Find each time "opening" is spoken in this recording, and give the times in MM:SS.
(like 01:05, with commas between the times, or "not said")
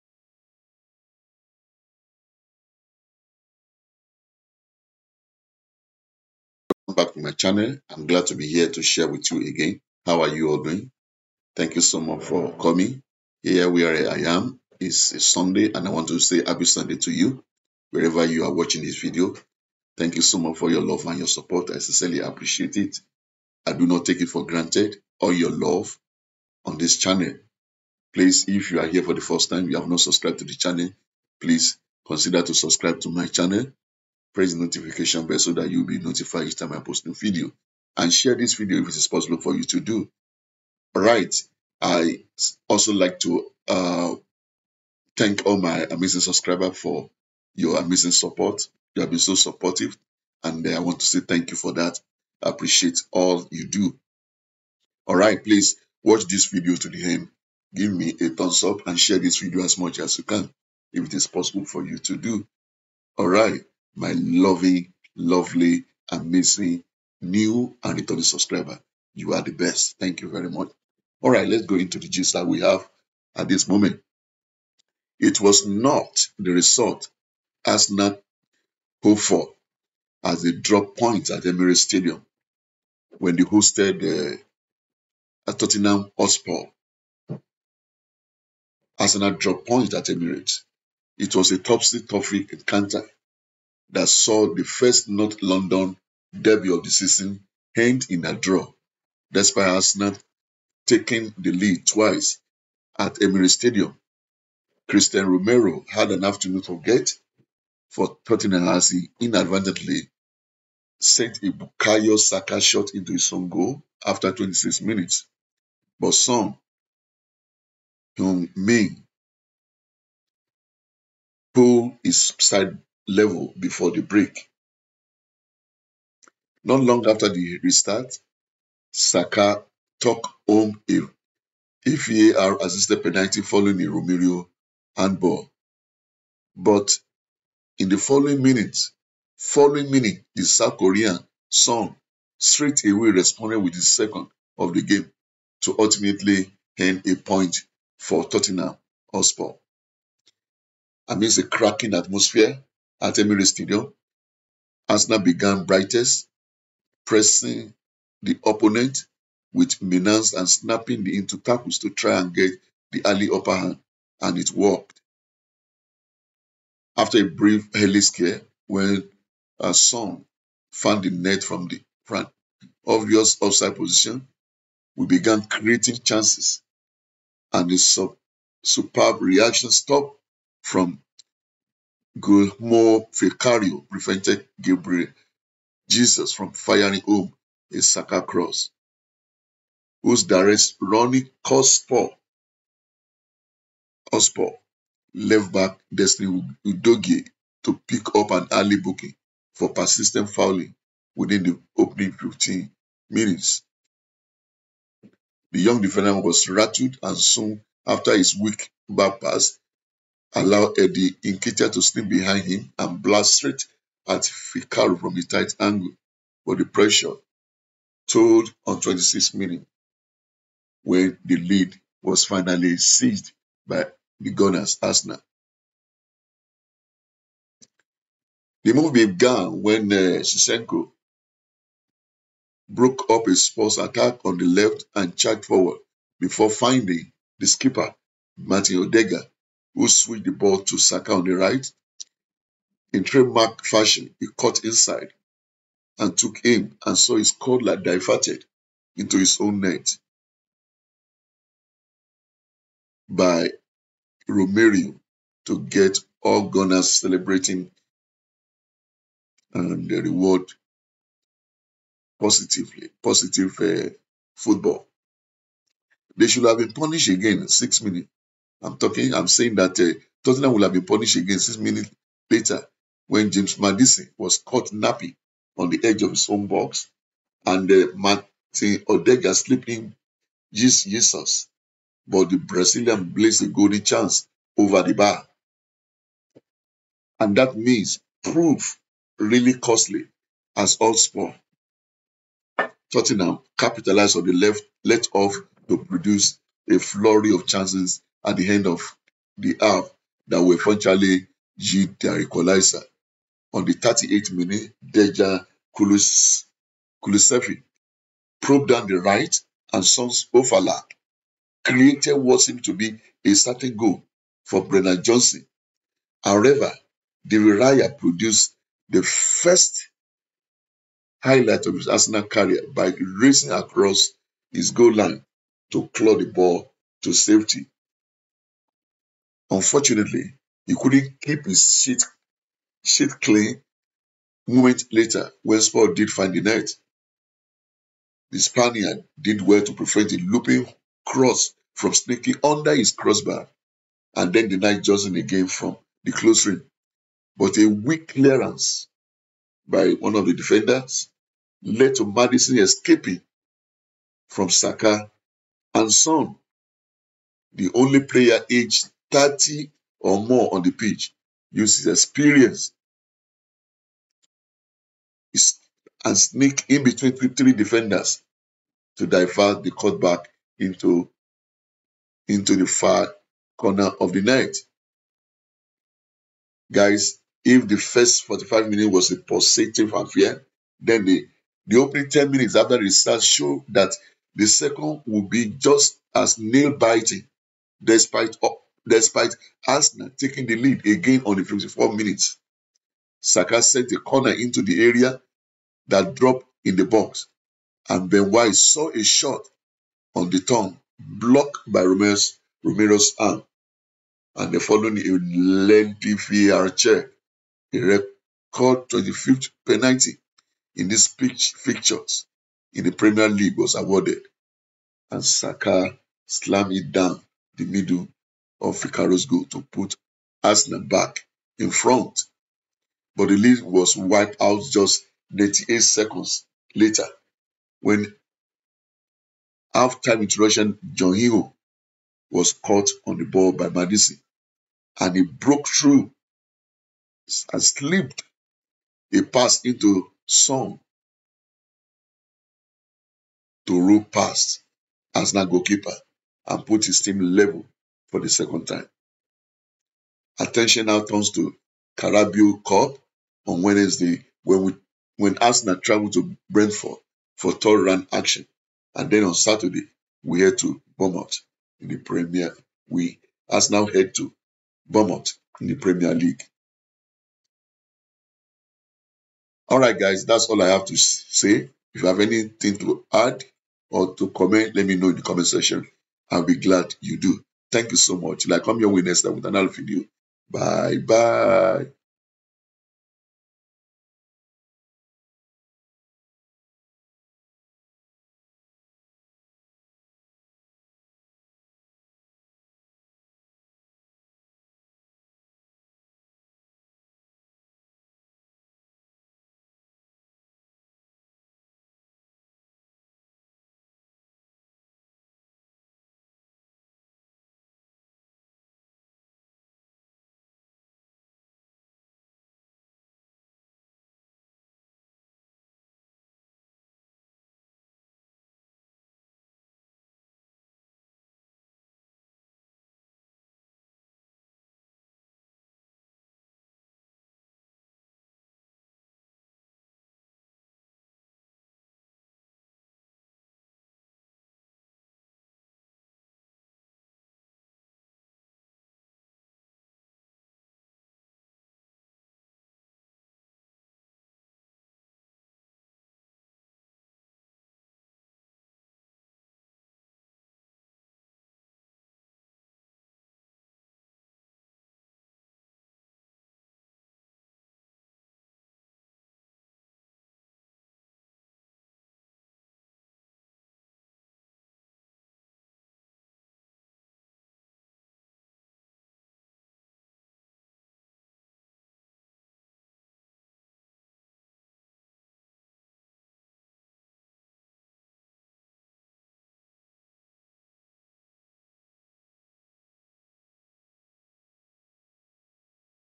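03:21, 06:21.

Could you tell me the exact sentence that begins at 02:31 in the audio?
Amidst a cracking atmosphere, at Emirates Stadium.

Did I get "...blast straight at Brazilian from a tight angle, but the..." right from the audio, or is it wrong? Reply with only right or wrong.
wrong.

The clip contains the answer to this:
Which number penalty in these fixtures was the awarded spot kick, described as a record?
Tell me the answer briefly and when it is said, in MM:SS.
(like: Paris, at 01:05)
25th, at 06:48.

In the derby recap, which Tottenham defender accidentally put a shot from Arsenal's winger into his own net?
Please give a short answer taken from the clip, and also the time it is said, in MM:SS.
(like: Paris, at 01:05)
Christian Romero, at 01:44.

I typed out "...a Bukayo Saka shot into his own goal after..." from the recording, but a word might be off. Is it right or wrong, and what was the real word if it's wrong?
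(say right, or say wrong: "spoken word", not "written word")
right.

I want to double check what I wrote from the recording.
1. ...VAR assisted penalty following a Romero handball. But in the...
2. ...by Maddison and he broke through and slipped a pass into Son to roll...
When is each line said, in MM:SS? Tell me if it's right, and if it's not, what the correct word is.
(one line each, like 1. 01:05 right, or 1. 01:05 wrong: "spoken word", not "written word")
1. 02:12 right
2. 07:13 right.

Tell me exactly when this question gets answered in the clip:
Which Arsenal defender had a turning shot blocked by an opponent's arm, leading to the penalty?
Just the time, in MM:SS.
06:38.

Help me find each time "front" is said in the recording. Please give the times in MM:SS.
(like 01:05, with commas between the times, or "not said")
02:52, 07:01.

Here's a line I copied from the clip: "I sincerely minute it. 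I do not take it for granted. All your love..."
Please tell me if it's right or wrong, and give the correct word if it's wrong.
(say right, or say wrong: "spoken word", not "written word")
wrong: "appreciate", not "minute".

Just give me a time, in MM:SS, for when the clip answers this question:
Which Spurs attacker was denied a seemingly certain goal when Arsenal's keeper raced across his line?
05:14.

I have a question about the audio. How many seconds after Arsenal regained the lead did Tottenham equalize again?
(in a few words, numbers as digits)
98.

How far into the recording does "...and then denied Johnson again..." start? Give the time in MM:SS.
05:44.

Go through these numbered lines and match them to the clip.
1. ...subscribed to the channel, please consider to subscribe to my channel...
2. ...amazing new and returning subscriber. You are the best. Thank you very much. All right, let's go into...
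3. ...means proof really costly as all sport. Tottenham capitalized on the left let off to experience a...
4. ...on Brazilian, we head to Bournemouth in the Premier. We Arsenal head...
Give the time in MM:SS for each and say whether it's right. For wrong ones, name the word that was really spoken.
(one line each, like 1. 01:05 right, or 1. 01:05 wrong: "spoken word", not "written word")
1. 00:29 right
2. 01:06 right
3. 04:47 wrong: "produce", not "experience"
4. 07:39 wrong: "Saturday", not "Brazilian".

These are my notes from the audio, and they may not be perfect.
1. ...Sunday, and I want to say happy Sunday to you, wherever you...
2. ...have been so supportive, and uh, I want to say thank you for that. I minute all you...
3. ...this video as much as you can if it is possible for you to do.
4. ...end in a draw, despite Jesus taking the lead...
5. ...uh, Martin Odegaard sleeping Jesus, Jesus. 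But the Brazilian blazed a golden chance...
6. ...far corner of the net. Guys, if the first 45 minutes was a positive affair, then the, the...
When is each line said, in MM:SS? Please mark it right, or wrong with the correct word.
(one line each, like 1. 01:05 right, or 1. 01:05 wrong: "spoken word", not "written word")
1. 00:15 right
2. 00:49 wrong: "appreciate", not "minute"
3. 00:59 right
4. 01:37 wrong: "Arsenal", not "Jesus"
5. 04:37 right
6. 06:12 right.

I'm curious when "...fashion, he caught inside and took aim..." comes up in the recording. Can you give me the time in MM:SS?
04:03.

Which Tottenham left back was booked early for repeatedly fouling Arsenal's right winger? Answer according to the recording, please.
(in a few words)
Destiny Udogie.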